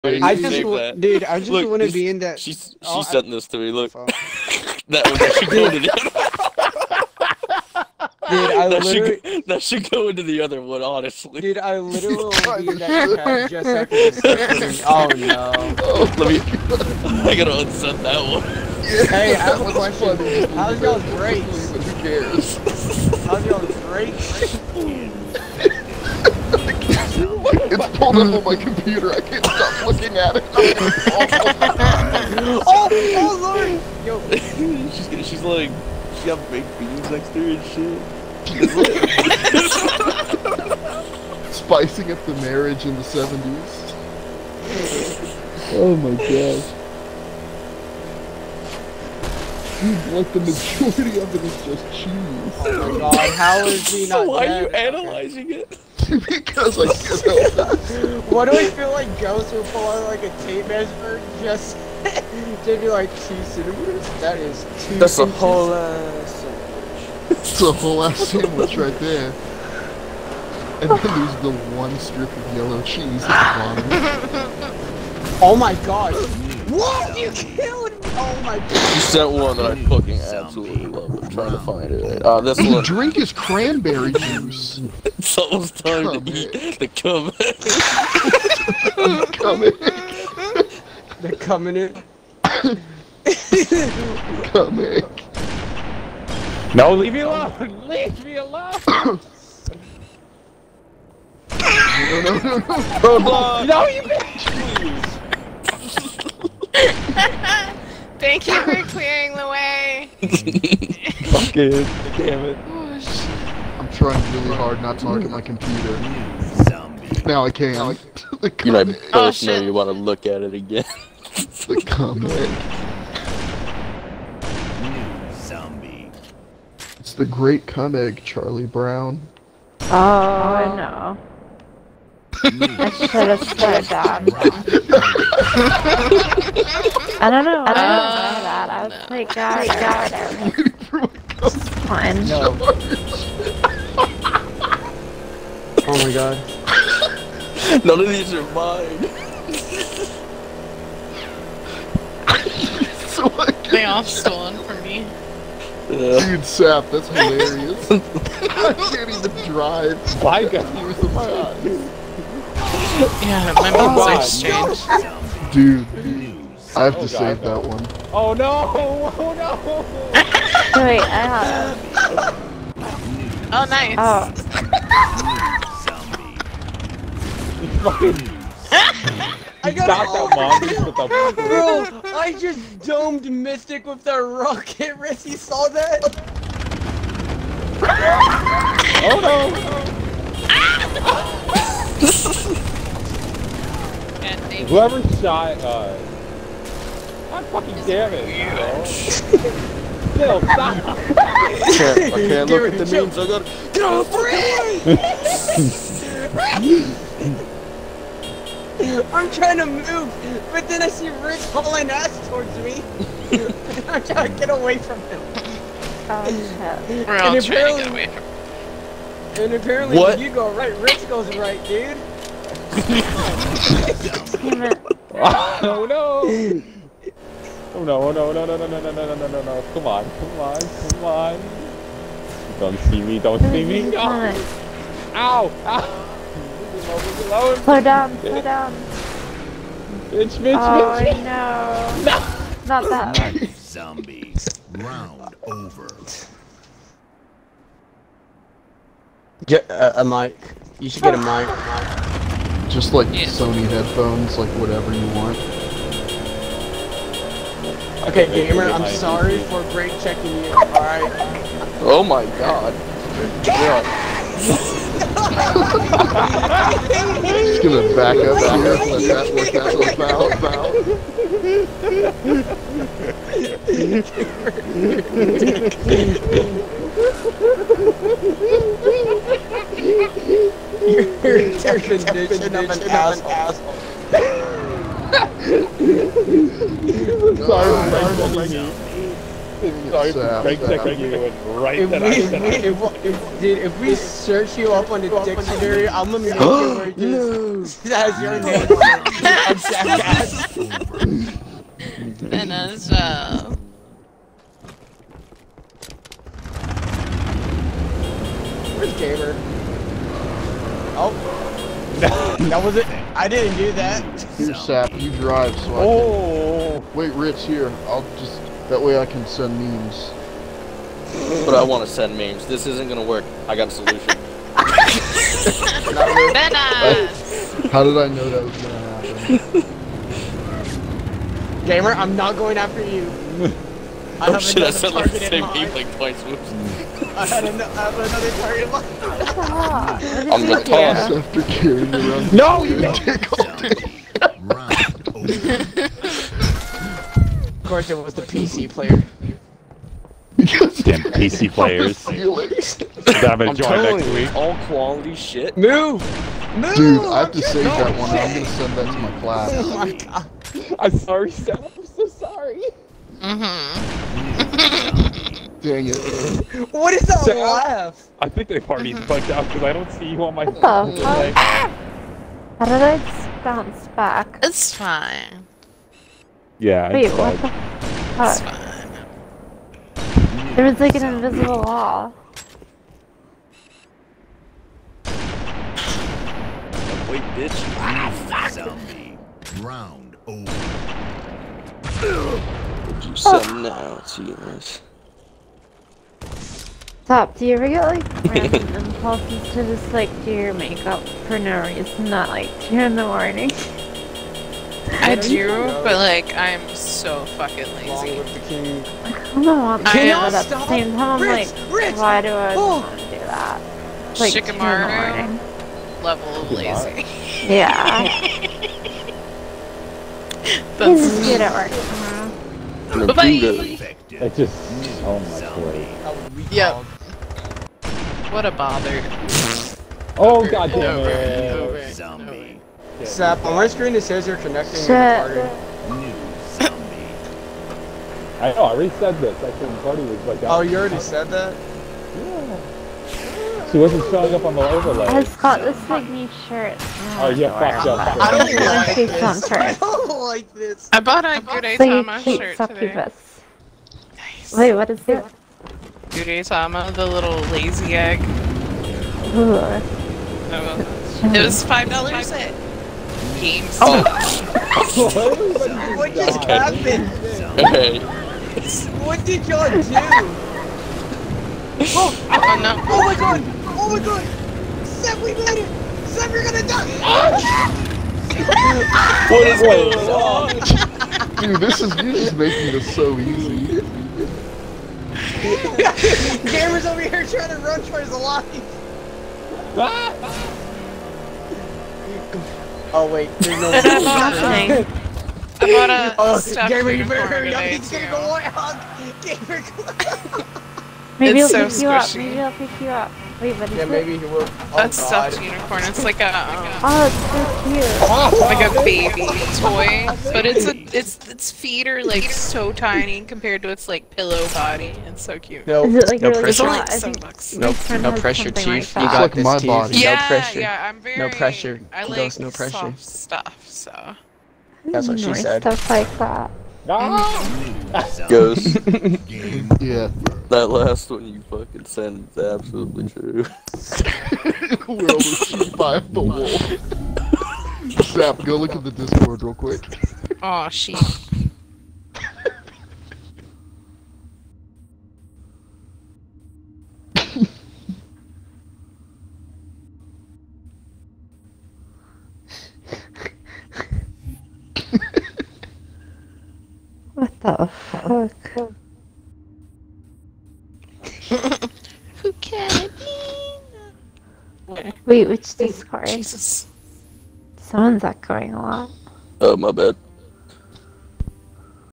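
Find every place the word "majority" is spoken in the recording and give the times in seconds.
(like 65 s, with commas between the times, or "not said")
50 s.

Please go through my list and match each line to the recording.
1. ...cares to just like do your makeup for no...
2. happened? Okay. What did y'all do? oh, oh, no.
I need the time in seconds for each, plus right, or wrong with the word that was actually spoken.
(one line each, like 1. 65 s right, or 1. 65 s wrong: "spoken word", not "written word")
1. 398 s wrong: "impulses", not "cares"
2. 466 s right.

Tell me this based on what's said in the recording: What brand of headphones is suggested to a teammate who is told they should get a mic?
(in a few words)
Sony.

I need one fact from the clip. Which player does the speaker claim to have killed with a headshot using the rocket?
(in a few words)
Mystic.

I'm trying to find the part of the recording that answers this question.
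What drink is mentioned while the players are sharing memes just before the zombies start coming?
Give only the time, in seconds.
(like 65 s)
83 s.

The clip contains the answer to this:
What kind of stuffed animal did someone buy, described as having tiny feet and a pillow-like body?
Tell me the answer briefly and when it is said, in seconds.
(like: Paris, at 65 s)
unicorn, at 505 s.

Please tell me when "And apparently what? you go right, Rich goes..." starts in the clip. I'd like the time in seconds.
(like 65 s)
219 s.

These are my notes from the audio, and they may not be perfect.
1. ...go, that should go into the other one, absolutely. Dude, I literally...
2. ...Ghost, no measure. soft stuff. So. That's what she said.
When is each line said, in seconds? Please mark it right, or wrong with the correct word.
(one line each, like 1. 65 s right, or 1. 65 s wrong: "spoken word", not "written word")
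1. 9 s wrong: "honestly", not "absolutely"
2. 522 s wrong: "pressure", not "measure".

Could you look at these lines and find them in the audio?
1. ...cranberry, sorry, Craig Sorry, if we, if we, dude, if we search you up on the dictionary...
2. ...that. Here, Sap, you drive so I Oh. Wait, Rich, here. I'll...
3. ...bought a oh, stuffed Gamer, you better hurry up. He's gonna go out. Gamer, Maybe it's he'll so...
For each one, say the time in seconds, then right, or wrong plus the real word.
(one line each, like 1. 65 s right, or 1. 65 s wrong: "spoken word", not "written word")
1. 287 s wrong: "sorry", not "cranberry"
2. 313 s right
3. 495 s right.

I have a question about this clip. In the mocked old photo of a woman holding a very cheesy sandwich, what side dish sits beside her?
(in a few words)
baked beans.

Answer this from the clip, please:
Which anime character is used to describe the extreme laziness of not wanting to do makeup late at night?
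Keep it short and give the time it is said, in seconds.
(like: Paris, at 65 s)
Shikamaru, at 414 s.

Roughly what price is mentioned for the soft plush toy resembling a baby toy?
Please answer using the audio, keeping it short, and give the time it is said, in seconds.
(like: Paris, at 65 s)
7 bucks, at 516 s.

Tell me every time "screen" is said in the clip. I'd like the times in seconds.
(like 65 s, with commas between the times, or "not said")
433 s.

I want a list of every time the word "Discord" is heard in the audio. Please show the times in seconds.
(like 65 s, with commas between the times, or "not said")
538 s, 565 s.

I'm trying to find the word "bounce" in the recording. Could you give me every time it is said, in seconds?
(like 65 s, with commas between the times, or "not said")
373 s.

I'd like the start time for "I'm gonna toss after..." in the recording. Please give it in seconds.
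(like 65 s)
340 s.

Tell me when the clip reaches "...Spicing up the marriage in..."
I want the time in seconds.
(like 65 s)
41 s.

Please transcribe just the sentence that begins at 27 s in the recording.
it's pulled up on my computer.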